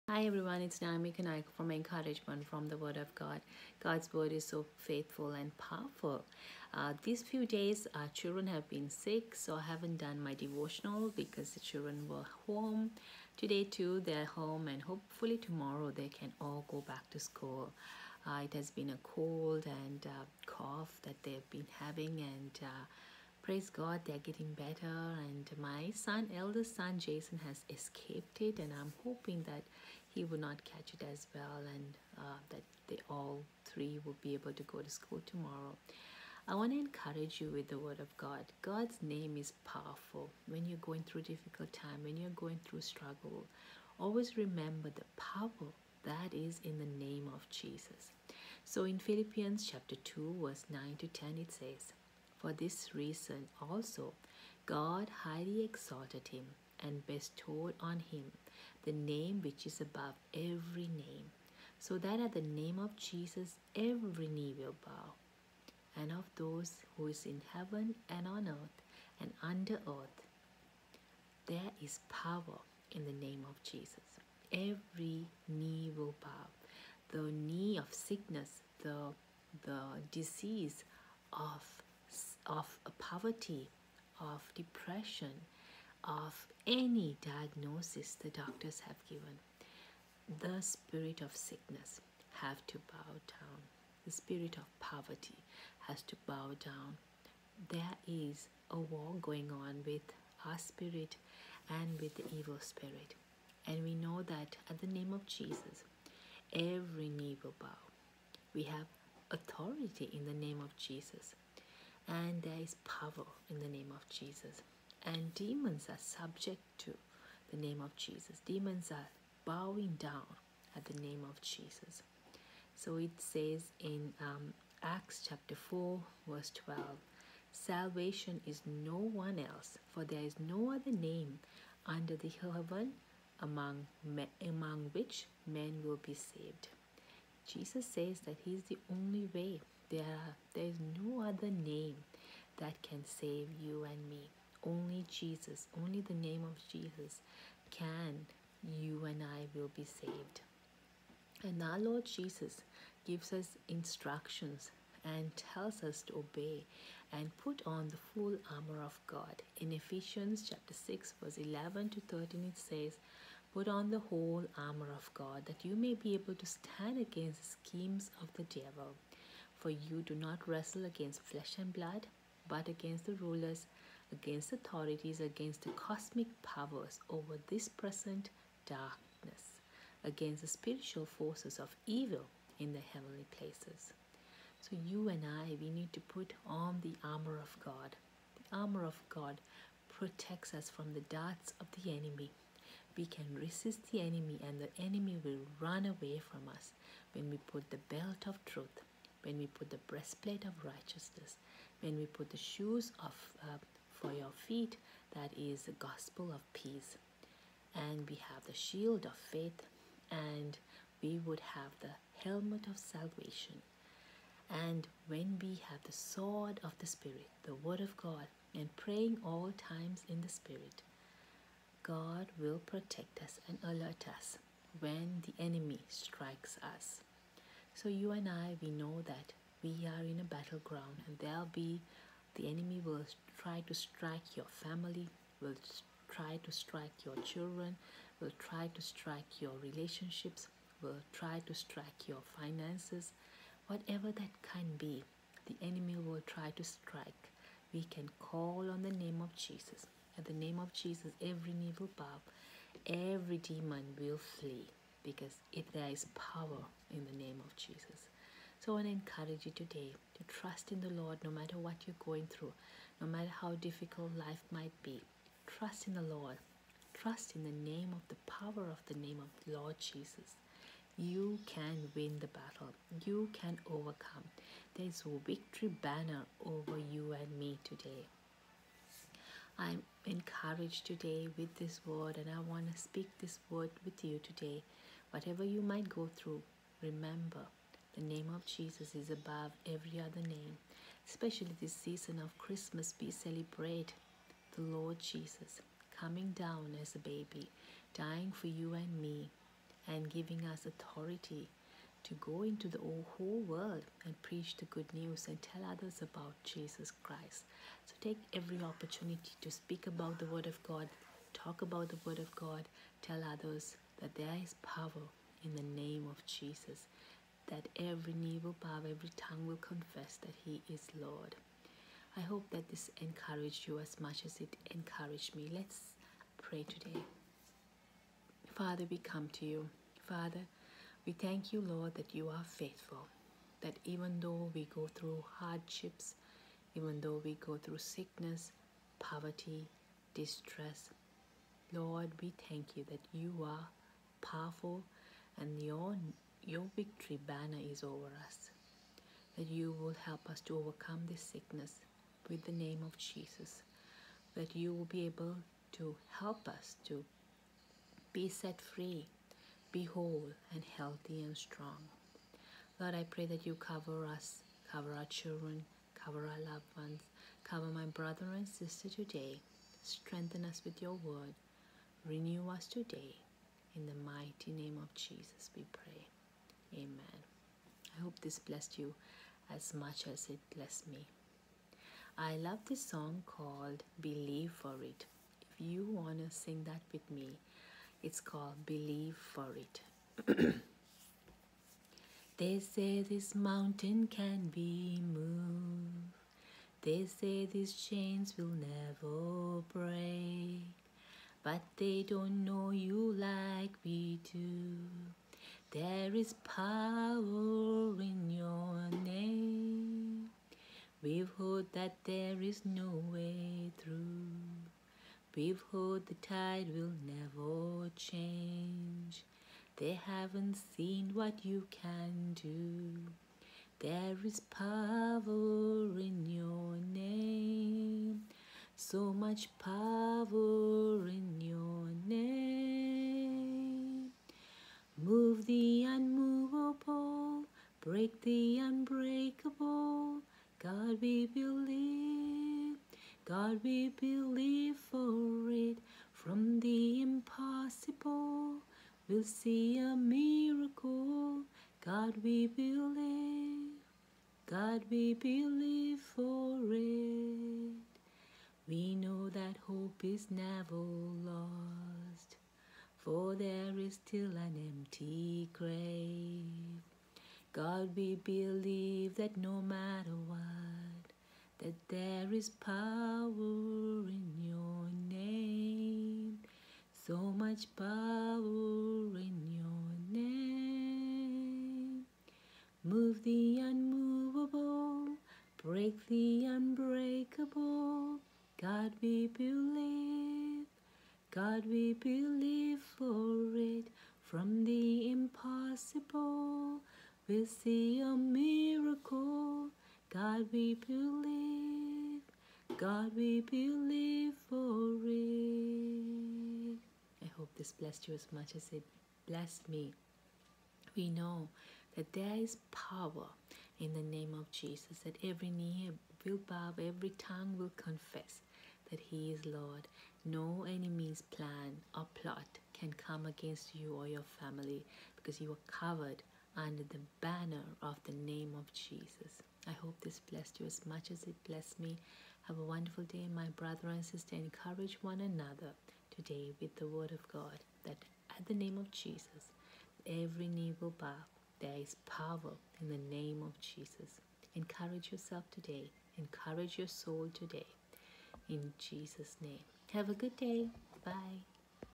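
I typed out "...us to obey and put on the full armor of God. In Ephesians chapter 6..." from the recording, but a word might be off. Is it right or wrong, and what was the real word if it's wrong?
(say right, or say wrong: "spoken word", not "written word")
right.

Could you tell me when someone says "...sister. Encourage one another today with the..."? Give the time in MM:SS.
08:54.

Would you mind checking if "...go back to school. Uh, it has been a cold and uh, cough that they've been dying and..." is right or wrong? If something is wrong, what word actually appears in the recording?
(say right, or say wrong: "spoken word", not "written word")
wrong: "having", not "dying".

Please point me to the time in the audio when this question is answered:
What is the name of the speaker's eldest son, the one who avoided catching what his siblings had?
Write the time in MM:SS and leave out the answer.
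00:26.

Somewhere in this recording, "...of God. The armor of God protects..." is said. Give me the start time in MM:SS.
03:07.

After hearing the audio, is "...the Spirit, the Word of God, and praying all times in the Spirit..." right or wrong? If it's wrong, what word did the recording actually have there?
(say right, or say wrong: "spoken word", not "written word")
right.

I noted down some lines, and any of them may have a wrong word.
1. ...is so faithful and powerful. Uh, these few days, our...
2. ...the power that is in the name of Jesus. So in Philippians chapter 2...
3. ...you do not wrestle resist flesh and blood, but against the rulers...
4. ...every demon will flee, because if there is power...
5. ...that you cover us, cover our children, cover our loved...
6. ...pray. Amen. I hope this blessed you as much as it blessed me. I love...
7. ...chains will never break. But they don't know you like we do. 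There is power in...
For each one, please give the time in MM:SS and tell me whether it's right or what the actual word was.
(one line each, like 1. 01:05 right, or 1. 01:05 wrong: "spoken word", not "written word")
1. 00:04 right
2. 00:44 right
3. 02:49 wrong: "against", not "resist"
4. 04:12 right
5. 06:03 right
6. 06:15 right
7. 06:37 right.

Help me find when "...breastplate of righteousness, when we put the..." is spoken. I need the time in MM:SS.
03:19.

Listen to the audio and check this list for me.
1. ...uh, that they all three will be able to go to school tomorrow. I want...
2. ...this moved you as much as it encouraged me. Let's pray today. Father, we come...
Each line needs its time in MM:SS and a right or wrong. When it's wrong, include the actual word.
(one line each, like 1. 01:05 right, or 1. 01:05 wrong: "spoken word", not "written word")
1. 00:32 right
2. 05:22 wrong: "encouraged", not "moved".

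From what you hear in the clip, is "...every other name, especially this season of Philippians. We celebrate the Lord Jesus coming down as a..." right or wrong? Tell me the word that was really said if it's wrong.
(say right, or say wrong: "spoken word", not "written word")
wrong: "Christmas", not "Philippians".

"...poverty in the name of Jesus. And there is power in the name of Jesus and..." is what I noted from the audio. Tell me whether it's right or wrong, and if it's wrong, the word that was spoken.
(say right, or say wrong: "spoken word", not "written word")
wrong: "authority", not "poverty".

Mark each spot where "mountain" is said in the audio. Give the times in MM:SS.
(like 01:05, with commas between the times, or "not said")
06:33.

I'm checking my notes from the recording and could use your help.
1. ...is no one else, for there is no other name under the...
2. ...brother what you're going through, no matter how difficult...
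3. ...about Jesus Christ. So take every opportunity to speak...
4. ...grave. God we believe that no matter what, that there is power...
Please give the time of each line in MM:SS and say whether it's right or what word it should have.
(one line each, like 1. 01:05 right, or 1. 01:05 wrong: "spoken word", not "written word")
1. 02:08 right
2. 04:21 wrong: "matter", not "brother"
3. 05:06 right
4. 07:45 right.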